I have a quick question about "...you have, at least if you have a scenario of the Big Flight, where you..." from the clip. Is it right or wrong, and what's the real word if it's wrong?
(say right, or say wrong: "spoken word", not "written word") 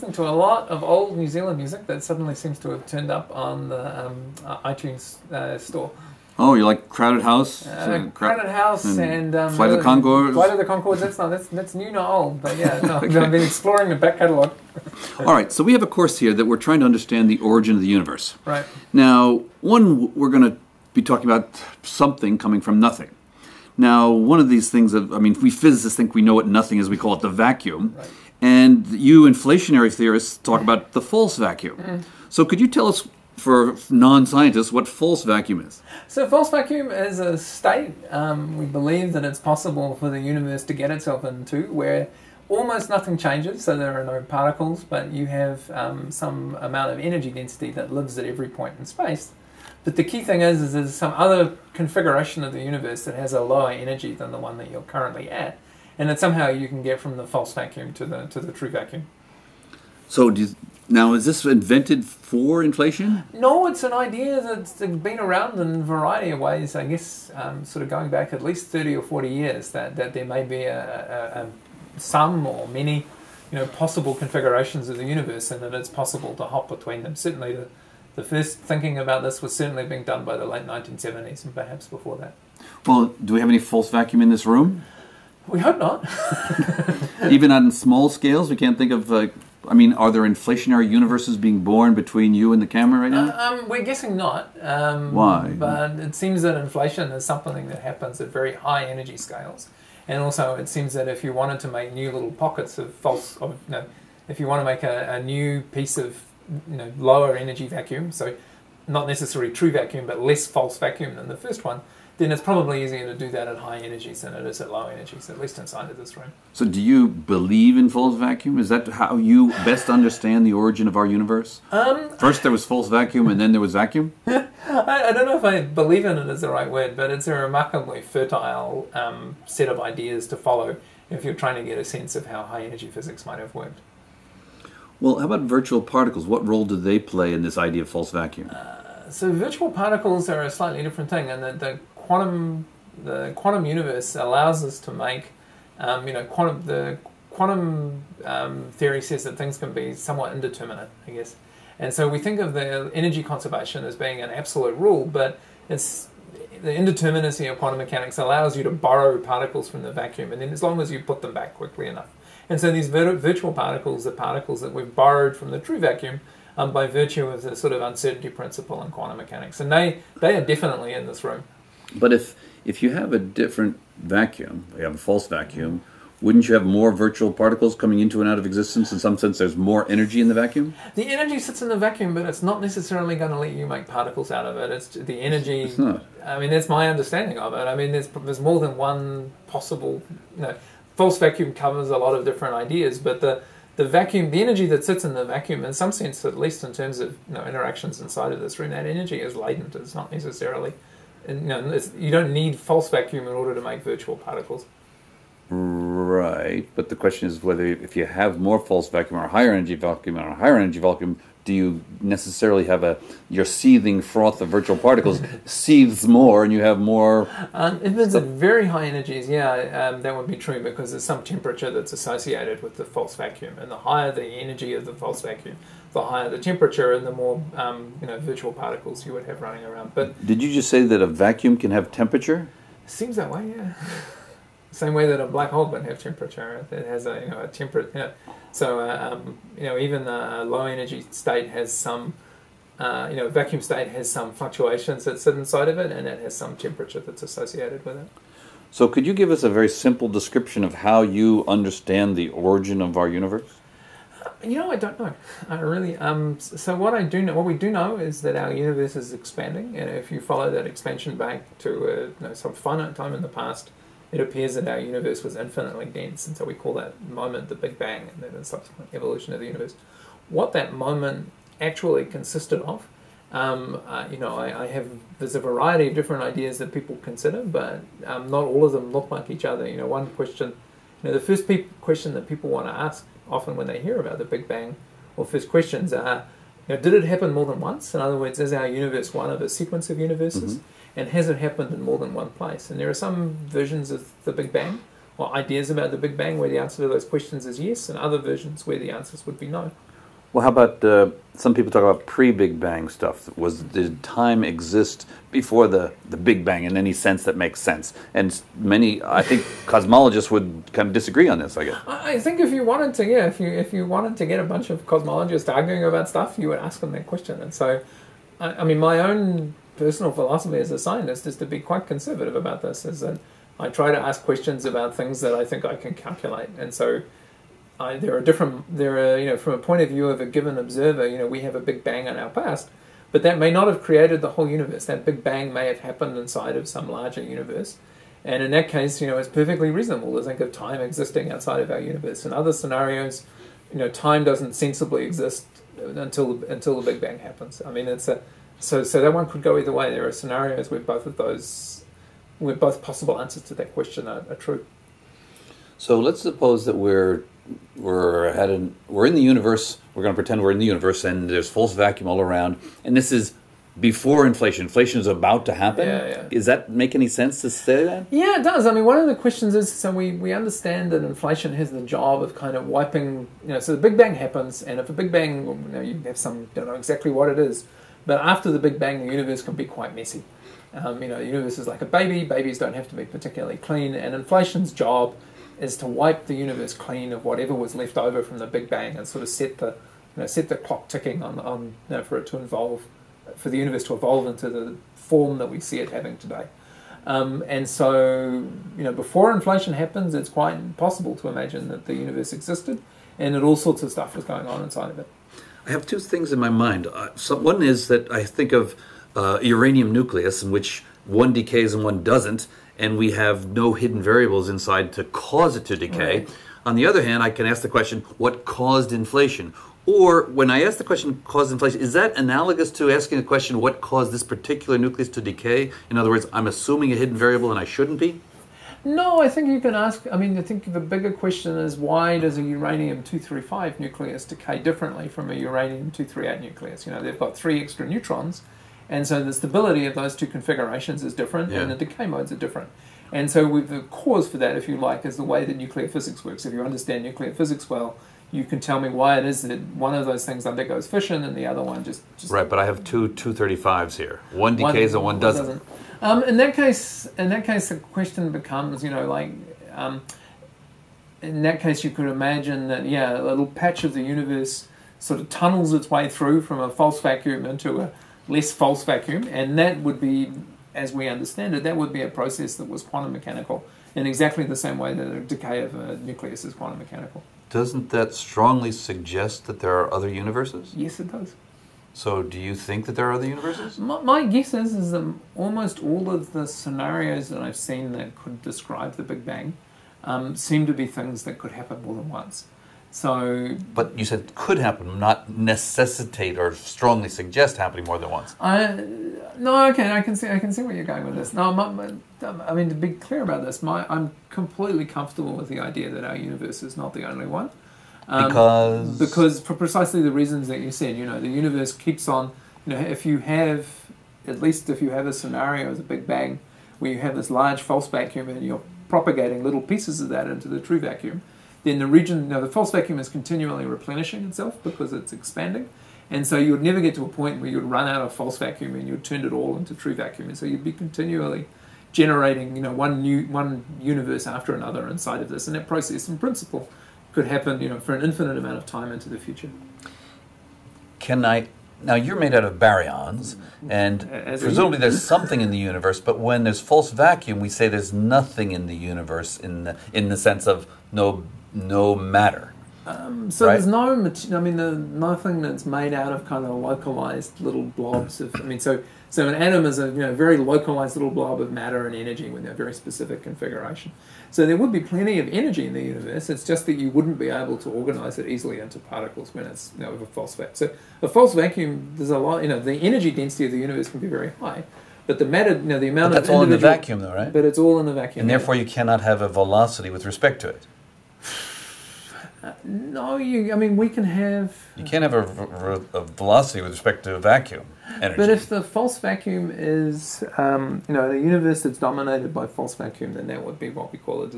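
wrong: "Bang", not "Flight".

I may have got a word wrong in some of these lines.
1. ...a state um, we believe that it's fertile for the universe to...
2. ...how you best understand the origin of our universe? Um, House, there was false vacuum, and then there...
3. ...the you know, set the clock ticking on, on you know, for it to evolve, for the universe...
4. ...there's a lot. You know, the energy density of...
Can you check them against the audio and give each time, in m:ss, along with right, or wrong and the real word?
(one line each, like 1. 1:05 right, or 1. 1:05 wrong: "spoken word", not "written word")
1. 0:37 wrong: "possible", not "fertile"
2. 1:58 wrong: "First", not "House"
3. 6:29 right
4. 9:31 right.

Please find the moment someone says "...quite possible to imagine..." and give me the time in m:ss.
6:40.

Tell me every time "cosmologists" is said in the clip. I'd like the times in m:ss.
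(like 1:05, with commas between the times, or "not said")
5:09, 5:14.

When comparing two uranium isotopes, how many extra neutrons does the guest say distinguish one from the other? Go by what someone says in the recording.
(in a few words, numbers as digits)
3.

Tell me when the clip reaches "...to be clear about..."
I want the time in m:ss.
8:22.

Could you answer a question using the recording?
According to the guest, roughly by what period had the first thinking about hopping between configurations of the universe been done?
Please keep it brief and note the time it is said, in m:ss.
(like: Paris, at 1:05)
late 1970s, at 1:20.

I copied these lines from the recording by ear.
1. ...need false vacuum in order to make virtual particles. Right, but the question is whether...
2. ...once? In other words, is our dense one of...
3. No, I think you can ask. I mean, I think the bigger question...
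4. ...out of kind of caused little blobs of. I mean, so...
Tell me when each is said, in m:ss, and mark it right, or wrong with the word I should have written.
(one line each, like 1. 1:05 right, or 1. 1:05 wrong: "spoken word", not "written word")
1. 3:22 right
2. 4:47 wrong: "universe", not "dense"
3. 7:08 right
4. 9:15 wrong: "localized", not "caused".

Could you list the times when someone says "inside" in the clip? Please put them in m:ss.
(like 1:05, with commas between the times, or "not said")
1:55, 3:18, 4:05, 5:36, 6:44, 6:54, 8:54.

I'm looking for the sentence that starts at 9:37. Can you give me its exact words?
But it's all in the vacuum, and therefore you cannot have a velocity with respect to it.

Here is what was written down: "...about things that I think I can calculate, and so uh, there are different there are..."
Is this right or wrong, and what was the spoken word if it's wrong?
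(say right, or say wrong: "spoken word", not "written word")
right.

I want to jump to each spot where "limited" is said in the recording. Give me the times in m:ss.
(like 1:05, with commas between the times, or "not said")
not said.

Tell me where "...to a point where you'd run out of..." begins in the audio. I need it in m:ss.
8:46.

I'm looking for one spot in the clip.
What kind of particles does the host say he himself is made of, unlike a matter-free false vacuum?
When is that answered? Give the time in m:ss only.
9:02.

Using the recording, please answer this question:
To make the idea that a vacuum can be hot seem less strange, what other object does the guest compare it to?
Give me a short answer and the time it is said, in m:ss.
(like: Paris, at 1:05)
a black hole, at 3:55.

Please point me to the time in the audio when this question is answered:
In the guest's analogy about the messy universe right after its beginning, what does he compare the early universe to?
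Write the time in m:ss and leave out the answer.
6:21.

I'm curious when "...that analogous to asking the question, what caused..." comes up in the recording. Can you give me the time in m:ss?
7:01.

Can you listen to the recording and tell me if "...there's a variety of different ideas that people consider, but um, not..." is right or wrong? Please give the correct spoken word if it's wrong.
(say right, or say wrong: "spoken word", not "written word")
right.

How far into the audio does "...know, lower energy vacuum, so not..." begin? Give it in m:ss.
1:46.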